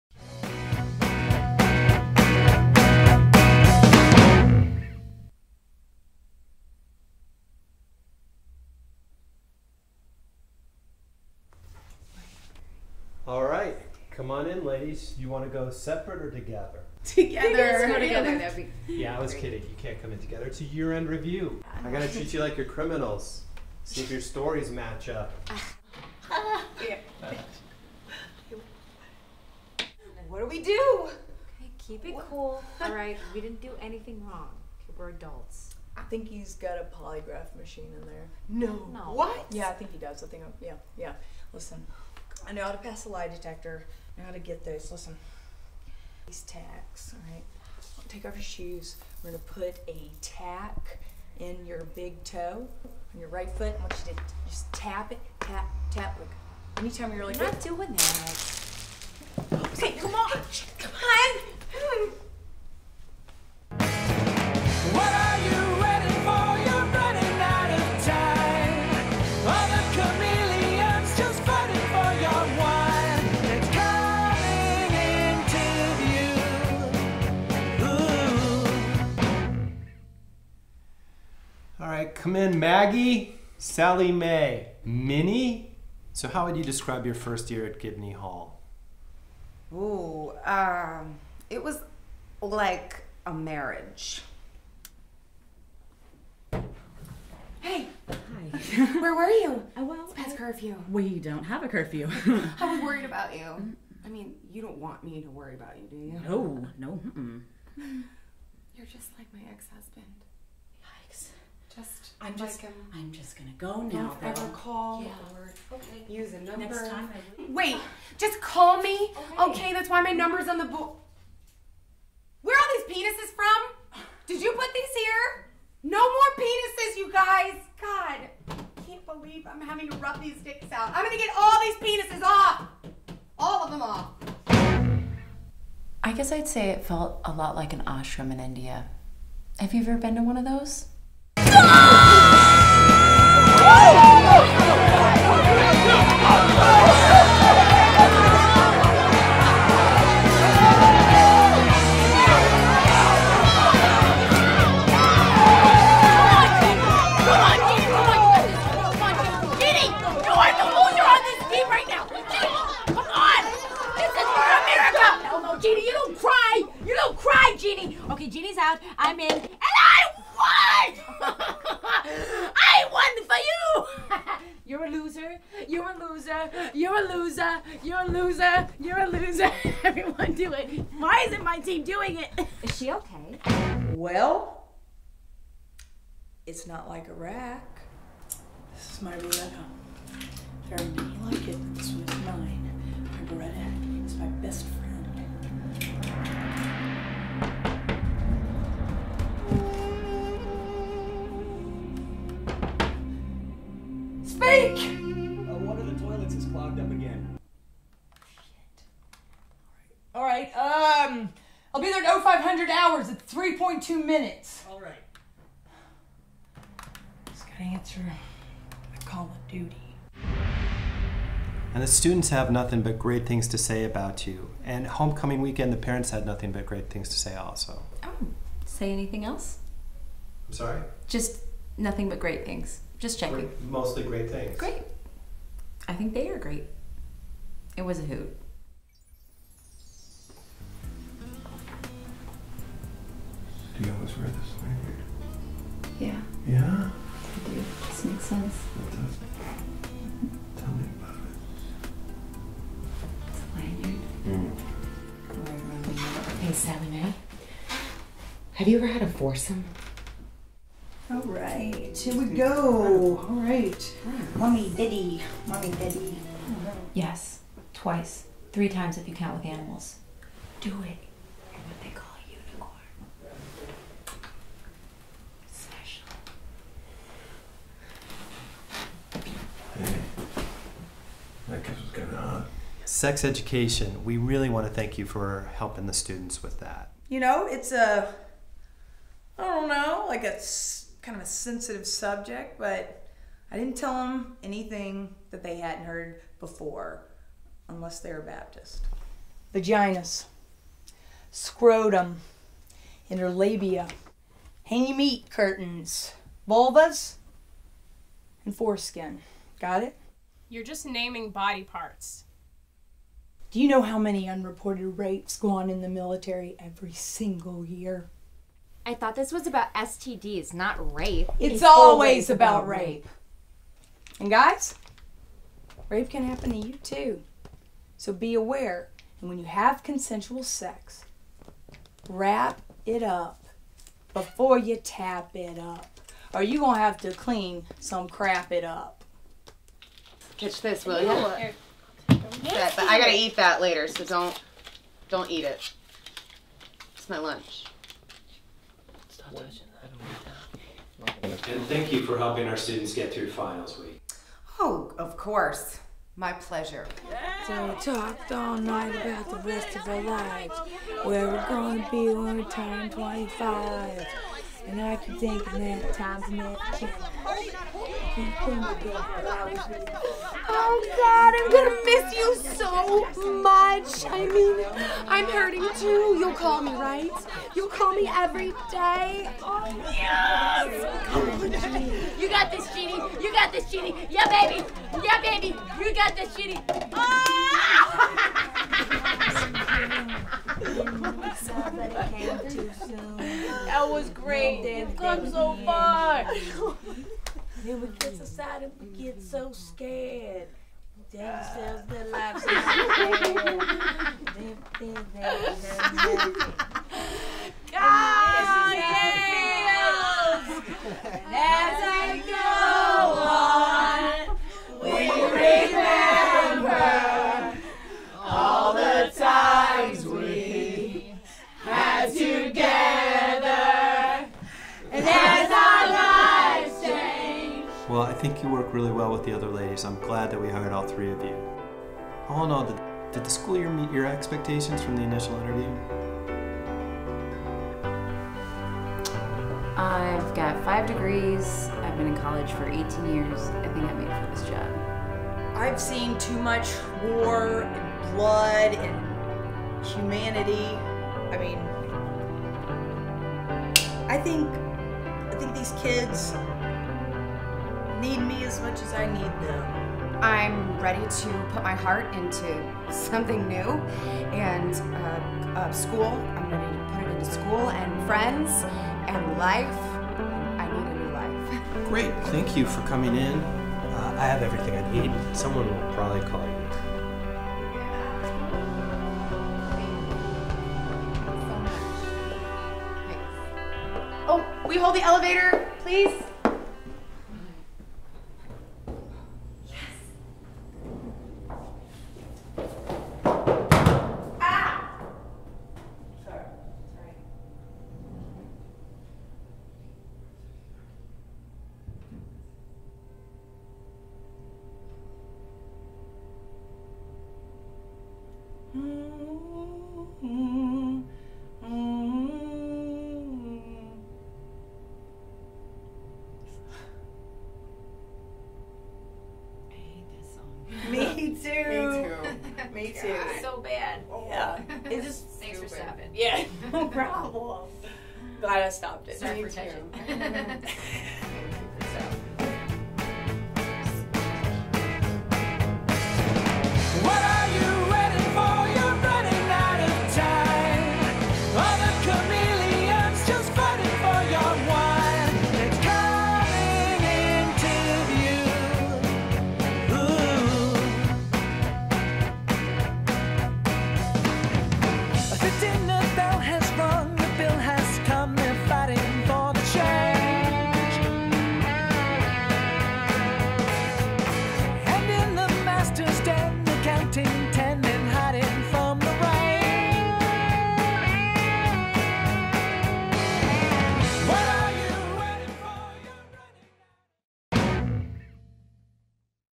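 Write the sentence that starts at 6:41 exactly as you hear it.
Tell ourselves their lives God, yes.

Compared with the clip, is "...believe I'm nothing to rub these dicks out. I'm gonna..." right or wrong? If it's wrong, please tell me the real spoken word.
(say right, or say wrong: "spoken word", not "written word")
wrong: "having", not "nothing".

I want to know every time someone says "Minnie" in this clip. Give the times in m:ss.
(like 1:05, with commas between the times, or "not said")
1:24.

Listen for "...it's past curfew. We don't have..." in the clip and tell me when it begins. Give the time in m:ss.
1:40.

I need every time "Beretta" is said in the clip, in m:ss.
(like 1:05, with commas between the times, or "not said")
3:09, 3:13.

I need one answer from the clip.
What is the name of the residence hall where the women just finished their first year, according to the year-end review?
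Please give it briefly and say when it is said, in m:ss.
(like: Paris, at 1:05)
Gibney Hall, at 1:27.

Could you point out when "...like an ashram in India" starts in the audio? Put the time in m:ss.
2:17.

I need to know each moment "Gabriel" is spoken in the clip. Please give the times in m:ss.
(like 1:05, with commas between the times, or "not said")
not said.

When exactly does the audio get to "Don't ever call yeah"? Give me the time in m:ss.
1:54.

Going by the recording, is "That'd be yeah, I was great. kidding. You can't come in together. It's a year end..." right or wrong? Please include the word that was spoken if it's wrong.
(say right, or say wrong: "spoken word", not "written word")
right.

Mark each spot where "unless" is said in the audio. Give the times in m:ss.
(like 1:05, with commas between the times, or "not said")
4:57.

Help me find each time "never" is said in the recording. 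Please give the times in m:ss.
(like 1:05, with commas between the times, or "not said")
6:06.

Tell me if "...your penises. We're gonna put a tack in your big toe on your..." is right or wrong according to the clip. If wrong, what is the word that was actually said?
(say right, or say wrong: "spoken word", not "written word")
wrong: "shoes", not "penises".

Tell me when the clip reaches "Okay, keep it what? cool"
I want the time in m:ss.
0:31.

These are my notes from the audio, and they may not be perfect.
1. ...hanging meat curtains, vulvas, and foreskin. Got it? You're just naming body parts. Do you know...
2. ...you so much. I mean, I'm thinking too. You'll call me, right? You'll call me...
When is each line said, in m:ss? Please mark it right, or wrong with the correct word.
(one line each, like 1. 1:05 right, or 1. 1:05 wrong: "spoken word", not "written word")
1. 5:04 right
2. 6:12 wrong: "hurting", not "thinking".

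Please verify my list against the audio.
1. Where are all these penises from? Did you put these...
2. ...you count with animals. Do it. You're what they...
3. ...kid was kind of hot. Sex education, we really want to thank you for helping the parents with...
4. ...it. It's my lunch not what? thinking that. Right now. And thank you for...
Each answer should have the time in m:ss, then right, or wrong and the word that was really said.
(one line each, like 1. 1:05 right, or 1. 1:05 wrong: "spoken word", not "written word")
1. 2:02 right
2. 4:29 right
3. 4:41 wrong: "students", not "parents"
4. 5:45 wrong: "touching", not "thinking".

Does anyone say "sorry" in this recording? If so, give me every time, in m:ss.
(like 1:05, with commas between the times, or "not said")
3:50, 8:49.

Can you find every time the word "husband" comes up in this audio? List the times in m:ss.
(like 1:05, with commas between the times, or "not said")
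1:49.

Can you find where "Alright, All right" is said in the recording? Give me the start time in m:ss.
3:30.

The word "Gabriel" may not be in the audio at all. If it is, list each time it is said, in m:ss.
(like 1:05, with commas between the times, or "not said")
not said.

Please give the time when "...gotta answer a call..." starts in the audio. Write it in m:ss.
3:37.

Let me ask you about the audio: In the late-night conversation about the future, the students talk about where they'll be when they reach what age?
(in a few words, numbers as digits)
25.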